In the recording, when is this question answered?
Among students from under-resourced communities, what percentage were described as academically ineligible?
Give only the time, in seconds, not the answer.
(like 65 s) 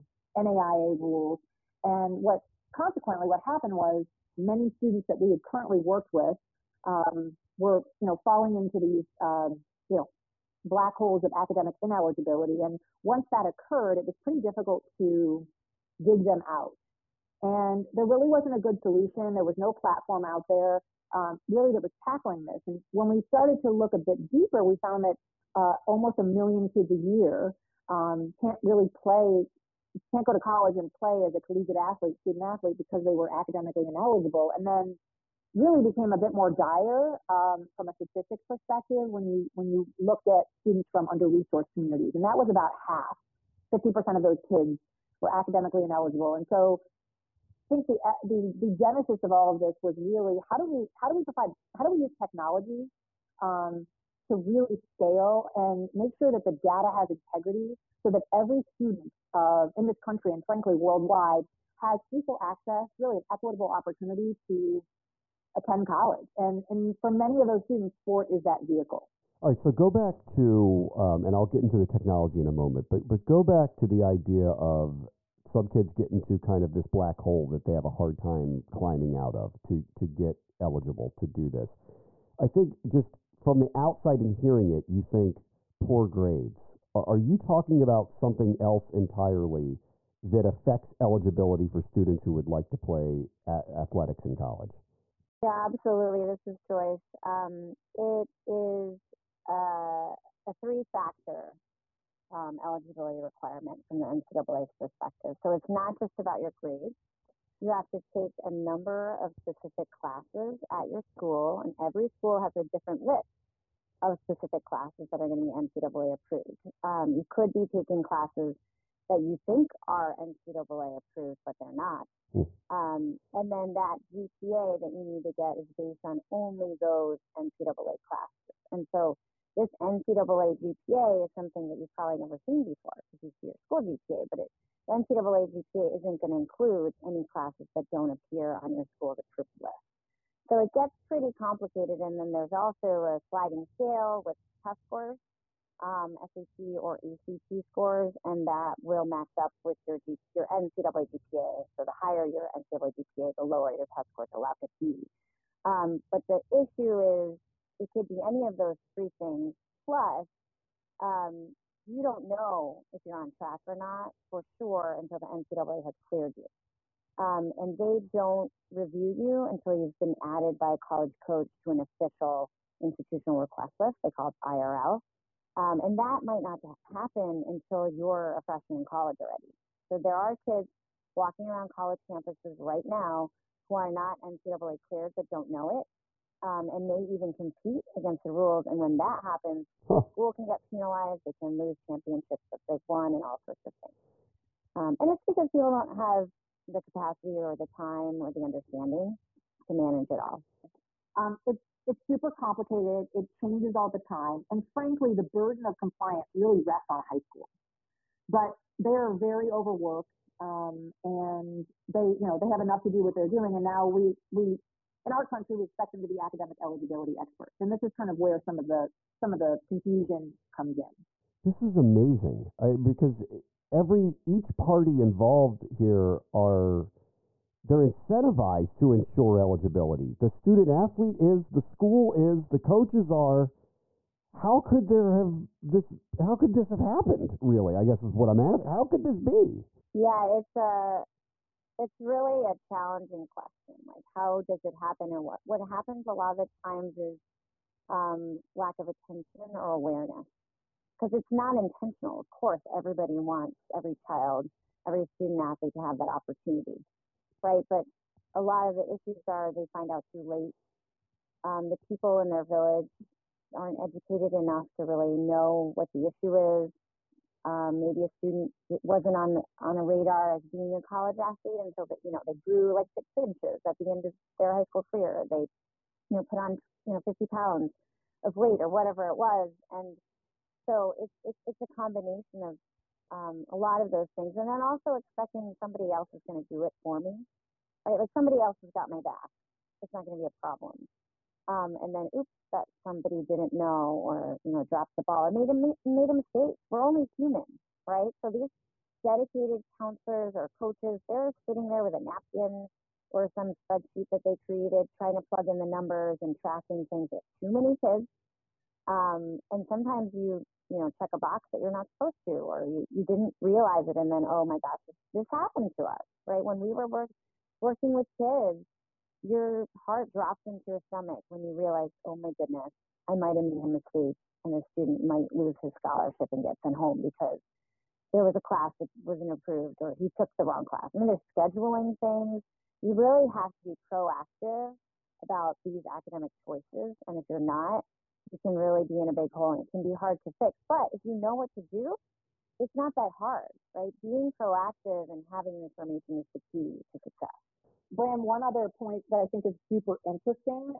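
43 s.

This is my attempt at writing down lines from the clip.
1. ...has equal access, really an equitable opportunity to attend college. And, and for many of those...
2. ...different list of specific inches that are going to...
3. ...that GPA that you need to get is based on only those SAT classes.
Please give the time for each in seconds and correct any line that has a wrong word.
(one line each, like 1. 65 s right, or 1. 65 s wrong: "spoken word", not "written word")
1. 61 s right
2. 112 s wrong: "classes", not "inches"
3. 123 s wrong: "NCAA", not "SAT".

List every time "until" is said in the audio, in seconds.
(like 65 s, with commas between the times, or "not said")
165 s, 169 s, 177 s, 271 s.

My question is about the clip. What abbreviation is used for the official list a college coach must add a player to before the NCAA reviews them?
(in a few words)
IRL.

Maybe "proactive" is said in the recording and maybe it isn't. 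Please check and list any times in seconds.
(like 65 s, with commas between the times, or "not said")
333 s, 344 s.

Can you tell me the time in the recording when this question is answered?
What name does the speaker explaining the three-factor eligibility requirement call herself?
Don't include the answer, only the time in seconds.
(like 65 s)
96 s.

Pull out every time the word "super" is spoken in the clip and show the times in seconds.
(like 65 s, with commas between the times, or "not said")
202 s, 349 s.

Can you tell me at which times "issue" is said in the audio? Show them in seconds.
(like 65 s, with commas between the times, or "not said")
156 s, 258 s, 266 s.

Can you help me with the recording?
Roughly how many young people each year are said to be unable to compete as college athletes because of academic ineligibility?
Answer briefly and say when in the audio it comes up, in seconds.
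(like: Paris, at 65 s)
almost a million, at 25 s.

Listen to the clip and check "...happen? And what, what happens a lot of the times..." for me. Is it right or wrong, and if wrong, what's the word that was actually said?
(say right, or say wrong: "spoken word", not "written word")
right.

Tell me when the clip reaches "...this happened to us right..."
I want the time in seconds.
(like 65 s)
315 s.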